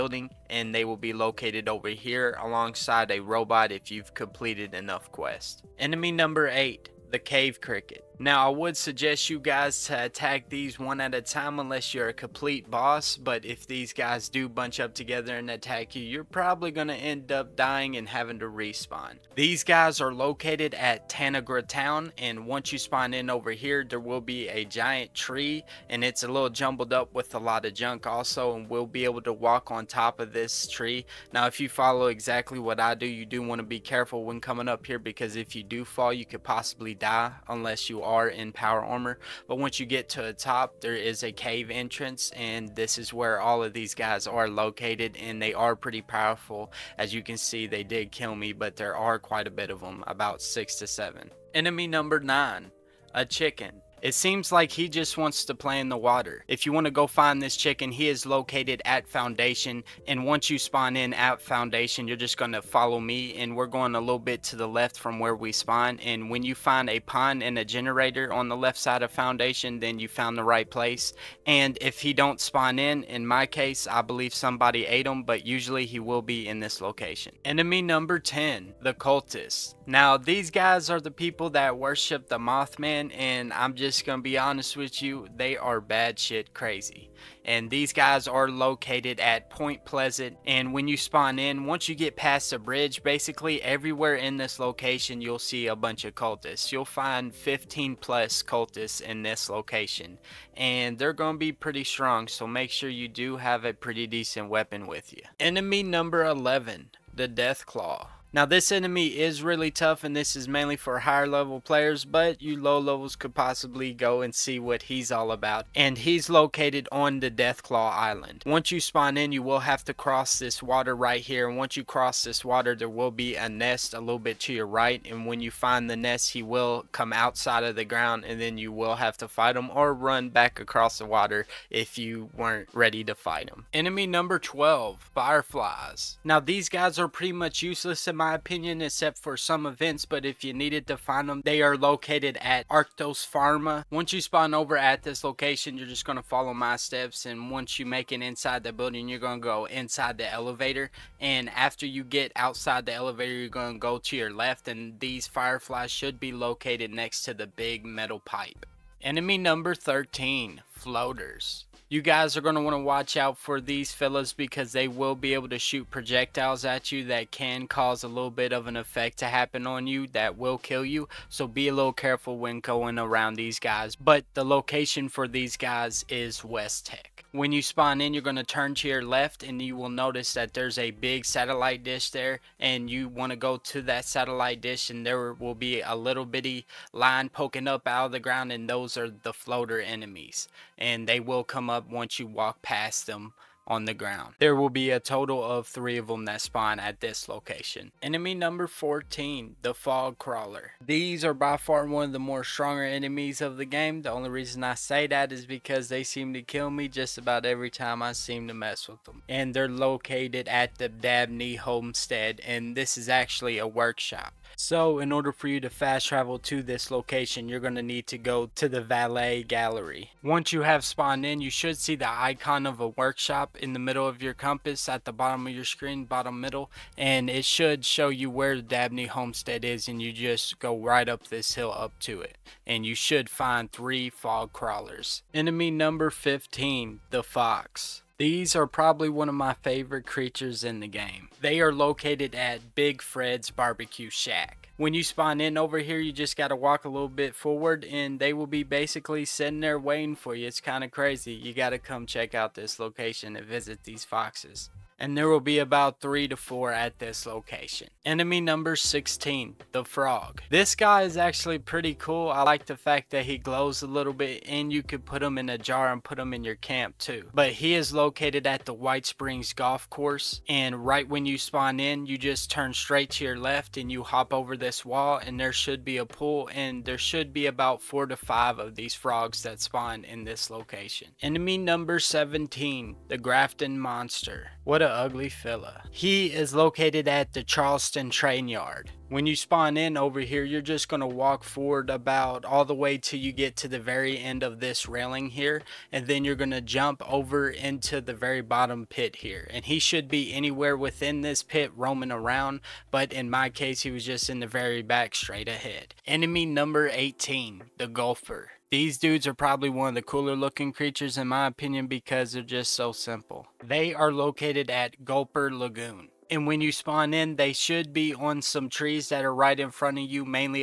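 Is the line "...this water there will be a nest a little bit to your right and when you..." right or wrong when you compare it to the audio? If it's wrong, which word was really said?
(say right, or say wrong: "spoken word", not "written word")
right.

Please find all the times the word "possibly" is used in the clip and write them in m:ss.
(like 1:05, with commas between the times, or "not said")
0:36, 1:53.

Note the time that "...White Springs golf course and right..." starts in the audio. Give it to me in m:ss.
4:28.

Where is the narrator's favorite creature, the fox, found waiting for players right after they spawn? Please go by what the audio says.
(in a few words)
Big Fred's Barbecue Shack.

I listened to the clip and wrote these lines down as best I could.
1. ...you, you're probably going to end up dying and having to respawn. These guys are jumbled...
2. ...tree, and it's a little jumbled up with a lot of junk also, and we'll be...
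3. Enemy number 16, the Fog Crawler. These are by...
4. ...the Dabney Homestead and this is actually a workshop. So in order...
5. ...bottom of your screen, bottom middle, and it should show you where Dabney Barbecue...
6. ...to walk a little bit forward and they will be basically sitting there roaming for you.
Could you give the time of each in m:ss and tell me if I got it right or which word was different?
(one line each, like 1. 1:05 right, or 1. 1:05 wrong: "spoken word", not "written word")
1. 0:15 wrong: "located", not "jumbled"
2. 0:25 right
3. 3:18 wrong: "14", not "16"
4. 3:30 right
5. 3:45 wrong: "Homestead", not "Barbecue"
6. 4:06 wrong: "waiting", not "roaming".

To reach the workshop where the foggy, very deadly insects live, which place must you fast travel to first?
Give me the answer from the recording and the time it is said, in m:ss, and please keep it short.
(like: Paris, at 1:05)
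Valley Galleria, at 3:38.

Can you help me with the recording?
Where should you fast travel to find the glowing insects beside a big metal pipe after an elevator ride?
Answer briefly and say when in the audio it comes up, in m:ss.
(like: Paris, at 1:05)
Arctos Pharma, at 2:22.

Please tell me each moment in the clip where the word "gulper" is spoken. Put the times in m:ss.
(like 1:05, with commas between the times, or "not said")
5:07, 5:15.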